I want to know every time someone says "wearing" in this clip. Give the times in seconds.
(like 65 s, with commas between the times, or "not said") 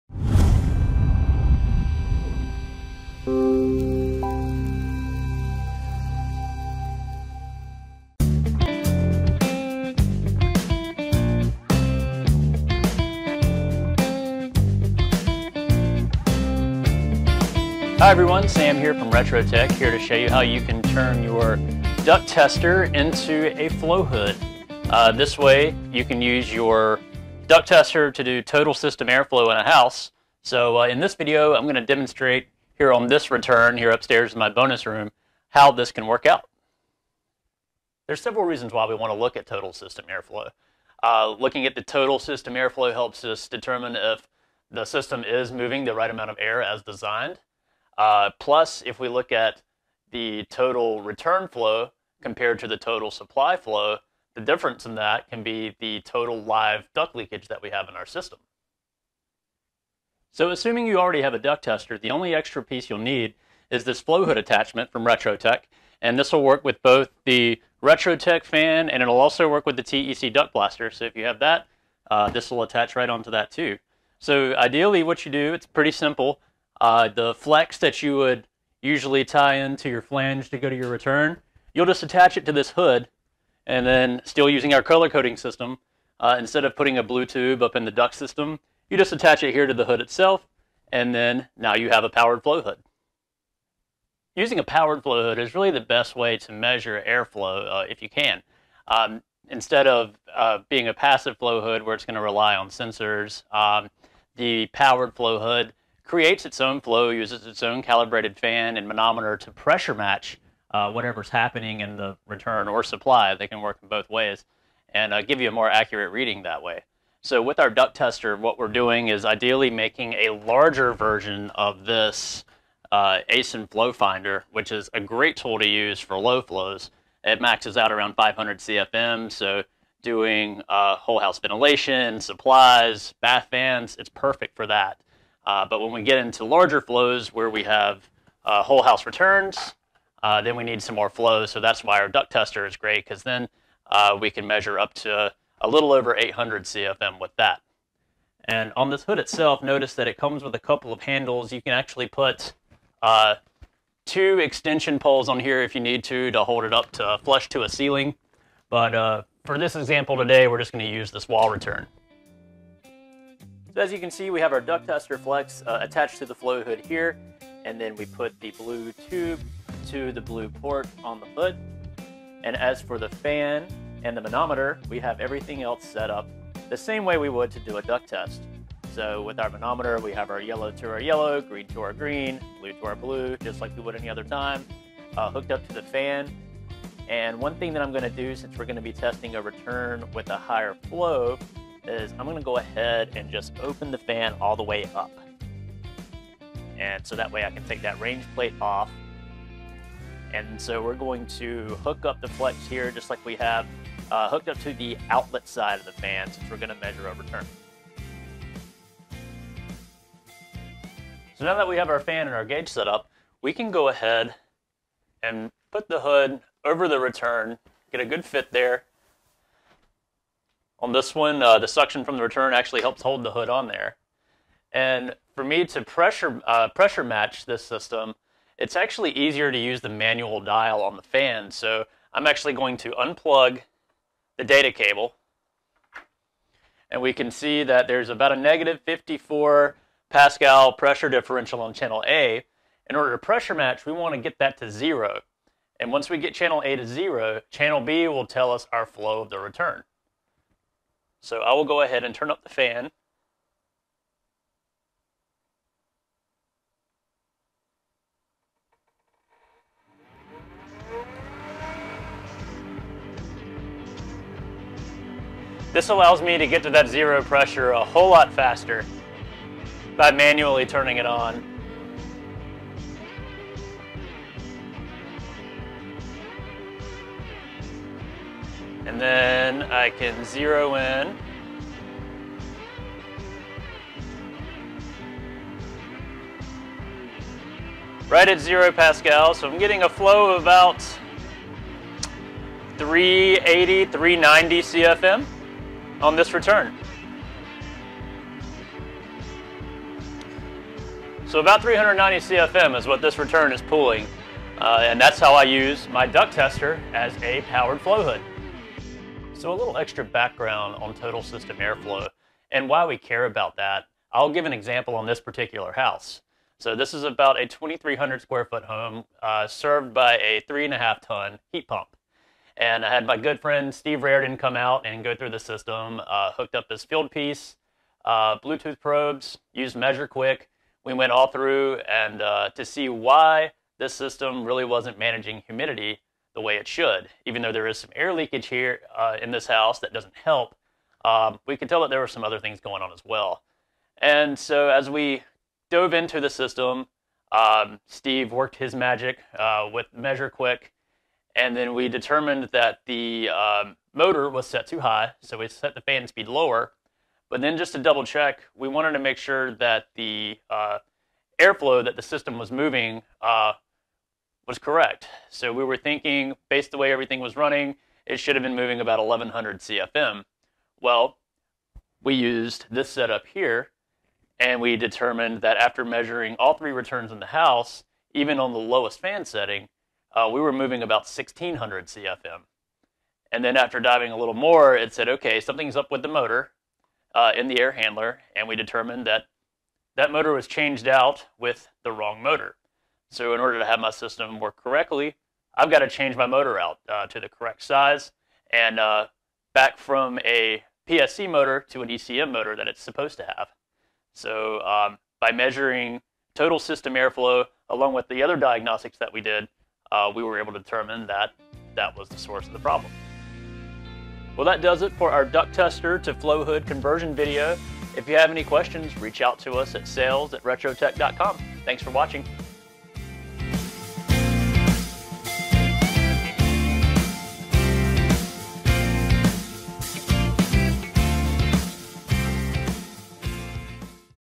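not said.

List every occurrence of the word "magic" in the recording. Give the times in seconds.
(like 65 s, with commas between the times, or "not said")
348 s.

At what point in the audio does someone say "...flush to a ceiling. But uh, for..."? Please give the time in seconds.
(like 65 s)
157 s.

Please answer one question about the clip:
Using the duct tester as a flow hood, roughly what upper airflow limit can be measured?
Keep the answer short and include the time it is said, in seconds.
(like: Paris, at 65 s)
800 CFM, at 146 s.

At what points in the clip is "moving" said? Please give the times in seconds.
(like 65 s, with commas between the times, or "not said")
45 s, 362 s, 368 s, 380 s.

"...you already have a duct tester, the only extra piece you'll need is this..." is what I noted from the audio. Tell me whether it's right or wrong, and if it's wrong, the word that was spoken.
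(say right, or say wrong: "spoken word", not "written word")
right.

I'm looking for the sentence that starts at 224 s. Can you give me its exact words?
And for me to pressure, uh, pressure match this system, it's actually easier to use the manual dial on the fan.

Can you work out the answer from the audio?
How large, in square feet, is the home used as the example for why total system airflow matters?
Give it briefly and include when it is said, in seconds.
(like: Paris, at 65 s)
2,300 square feet, at 317 s.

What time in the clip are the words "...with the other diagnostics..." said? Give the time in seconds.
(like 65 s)
407 s.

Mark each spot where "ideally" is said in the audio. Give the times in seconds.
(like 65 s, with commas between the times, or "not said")
74 s, 119 s.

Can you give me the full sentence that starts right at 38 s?
There's several reasons why we want to look at total system airflow.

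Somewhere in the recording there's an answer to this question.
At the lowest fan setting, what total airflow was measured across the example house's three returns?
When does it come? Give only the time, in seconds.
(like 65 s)
381 s.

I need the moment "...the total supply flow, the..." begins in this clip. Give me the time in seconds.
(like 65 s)
52 s.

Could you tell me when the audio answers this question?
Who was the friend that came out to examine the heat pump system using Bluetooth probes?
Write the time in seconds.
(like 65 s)
323 s.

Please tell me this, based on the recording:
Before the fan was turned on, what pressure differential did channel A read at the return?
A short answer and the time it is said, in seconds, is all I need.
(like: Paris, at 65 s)
-54 Pascal, at 238 s.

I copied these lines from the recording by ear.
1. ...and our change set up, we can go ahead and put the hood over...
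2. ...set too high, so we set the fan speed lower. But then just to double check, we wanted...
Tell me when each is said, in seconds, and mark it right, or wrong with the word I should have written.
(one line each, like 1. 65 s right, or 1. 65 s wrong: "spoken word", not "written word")
1. 212 s wrong: "gauge", not "change"
2. 354 s right.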